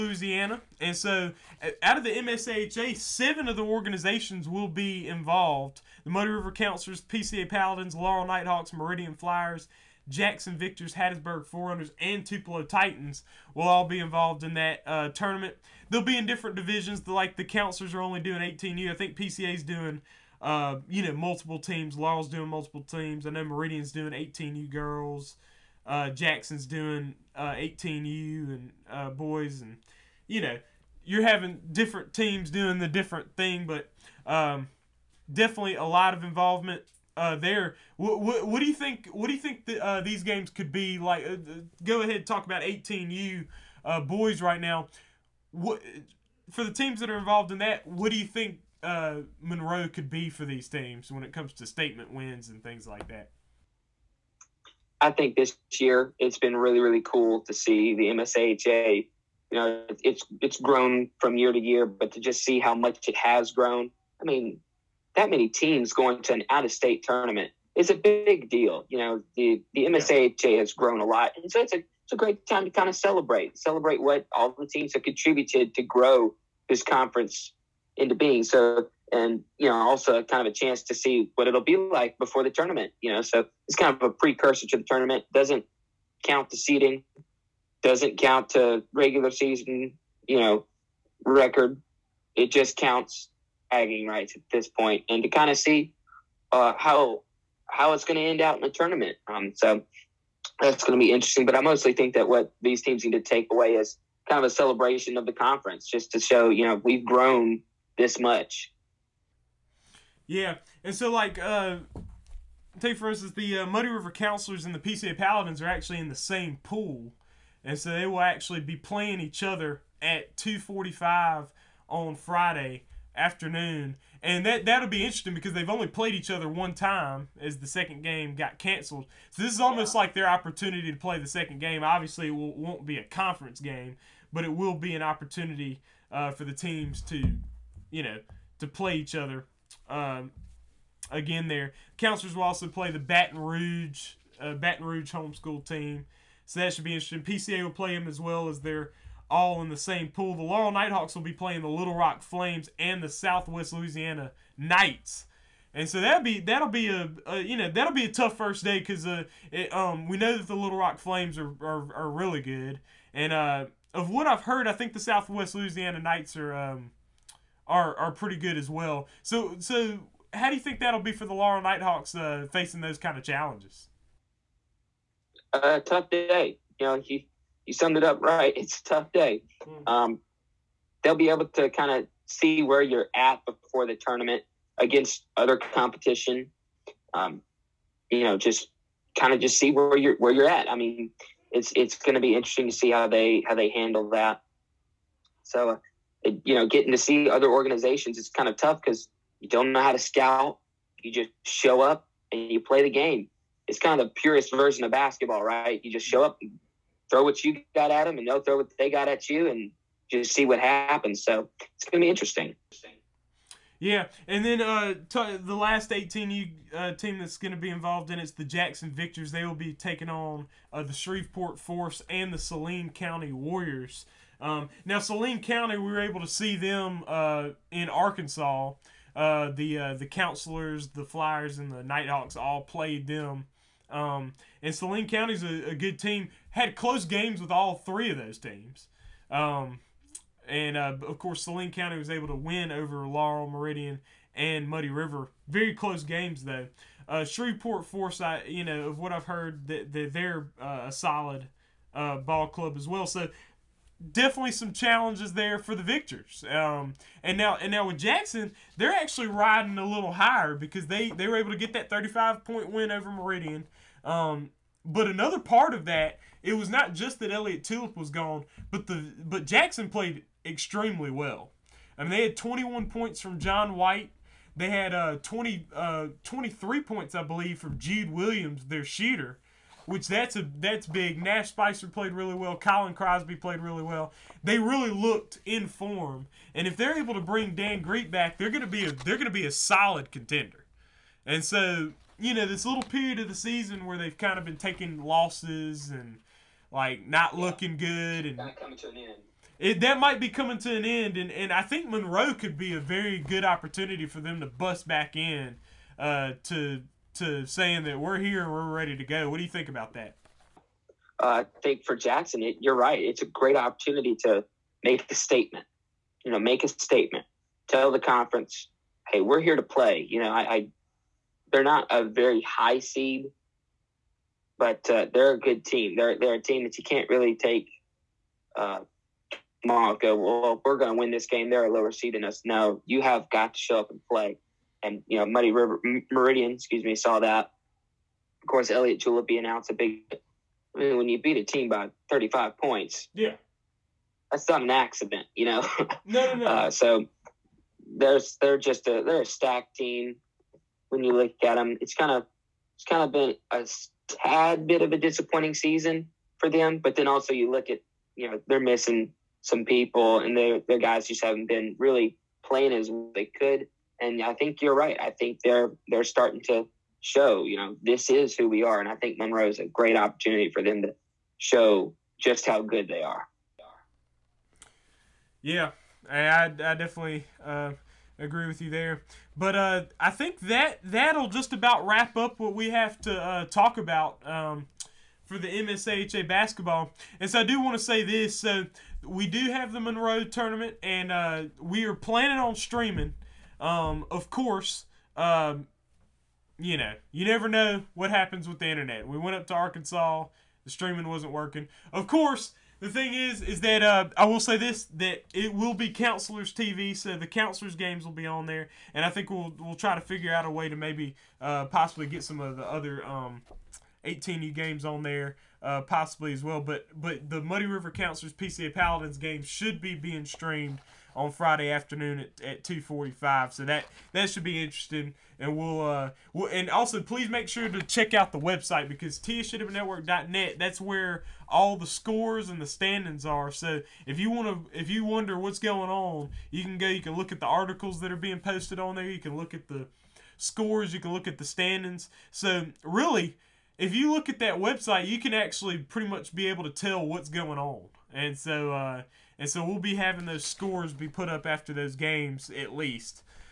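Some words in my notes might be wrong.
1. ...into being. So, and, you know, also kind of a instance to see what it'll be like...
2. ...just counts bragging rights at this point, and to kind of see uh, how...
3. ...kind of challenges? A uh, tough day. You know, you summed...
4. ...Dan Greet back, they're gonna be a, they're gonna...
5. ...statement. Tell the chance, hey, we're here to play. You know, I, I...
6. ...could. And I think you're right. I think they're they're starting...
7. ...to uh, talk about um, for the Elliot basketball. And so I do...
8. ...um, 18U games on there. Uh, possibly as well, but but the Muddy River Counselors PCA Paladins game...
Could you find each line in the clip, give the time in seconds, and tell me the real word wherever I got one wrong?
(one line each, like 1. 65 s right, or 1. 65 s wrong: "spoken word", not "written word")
1. 77 s wrong: "chance", not "instance"
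2. 92 s right
3. 172 s right
4. 287 s right
5. 316 s wrong: "conference", not "chance"
6. 363 s right
7. 383 s wrong: "MSAHA", not "Elliot"
8. 413 s right.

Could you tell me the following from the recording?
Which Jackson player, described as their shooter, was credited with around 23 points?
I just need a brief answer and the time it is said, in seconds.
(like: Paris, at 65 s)
Jude Williams, at 277 s.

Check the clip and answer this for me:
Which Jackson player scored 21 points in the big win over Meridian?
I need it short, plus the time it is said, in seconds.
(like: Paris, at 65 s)
John White, at 273 s.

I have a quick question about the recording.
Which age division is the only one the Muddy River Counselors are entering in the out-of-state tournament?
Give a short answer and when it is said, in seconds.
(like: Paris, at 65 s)
18U, at 17 s.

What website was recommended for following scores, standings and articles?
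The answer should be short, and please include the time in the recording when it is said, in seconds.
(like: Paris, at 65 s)
tsjwnetwork.net, at 429 s.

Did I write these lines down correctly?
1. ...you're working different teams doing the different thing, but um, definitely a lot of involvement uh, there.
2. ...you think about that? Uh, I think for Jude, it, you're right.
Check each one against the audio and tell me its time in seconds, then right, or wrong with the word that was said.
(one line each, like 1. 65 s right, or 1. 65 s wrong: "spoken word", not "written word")
1. 31 s wrong: "having", not "working"
2. 309 s wrong: "Jackson", not "Jude".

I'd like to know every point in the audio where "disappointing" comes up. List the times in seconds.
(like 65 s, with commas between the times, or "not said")
354 s.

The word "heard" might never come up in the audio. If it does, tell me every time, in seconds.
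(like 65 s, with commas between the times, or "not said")
164 s, 249 s.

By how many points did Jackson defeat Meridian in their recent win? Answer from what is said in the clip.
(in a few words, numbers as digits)
35.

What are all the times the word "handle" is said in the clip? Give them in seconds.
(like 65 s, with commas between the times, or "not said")
193 s.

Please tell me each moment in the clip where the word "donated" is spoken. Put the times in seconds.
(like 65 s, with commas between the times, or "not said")
not said.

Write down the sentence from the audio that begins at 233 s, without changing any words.
Um, and Saline County a, a good team had close games with all three of those teams.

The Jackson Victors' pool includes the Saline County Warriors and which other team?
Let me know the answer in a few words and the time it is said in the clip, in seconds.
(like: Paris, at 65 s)
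Shreveport Force, at 220 s.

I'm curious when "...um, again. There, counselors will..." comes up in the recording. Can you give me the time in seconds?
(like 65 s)
139 s.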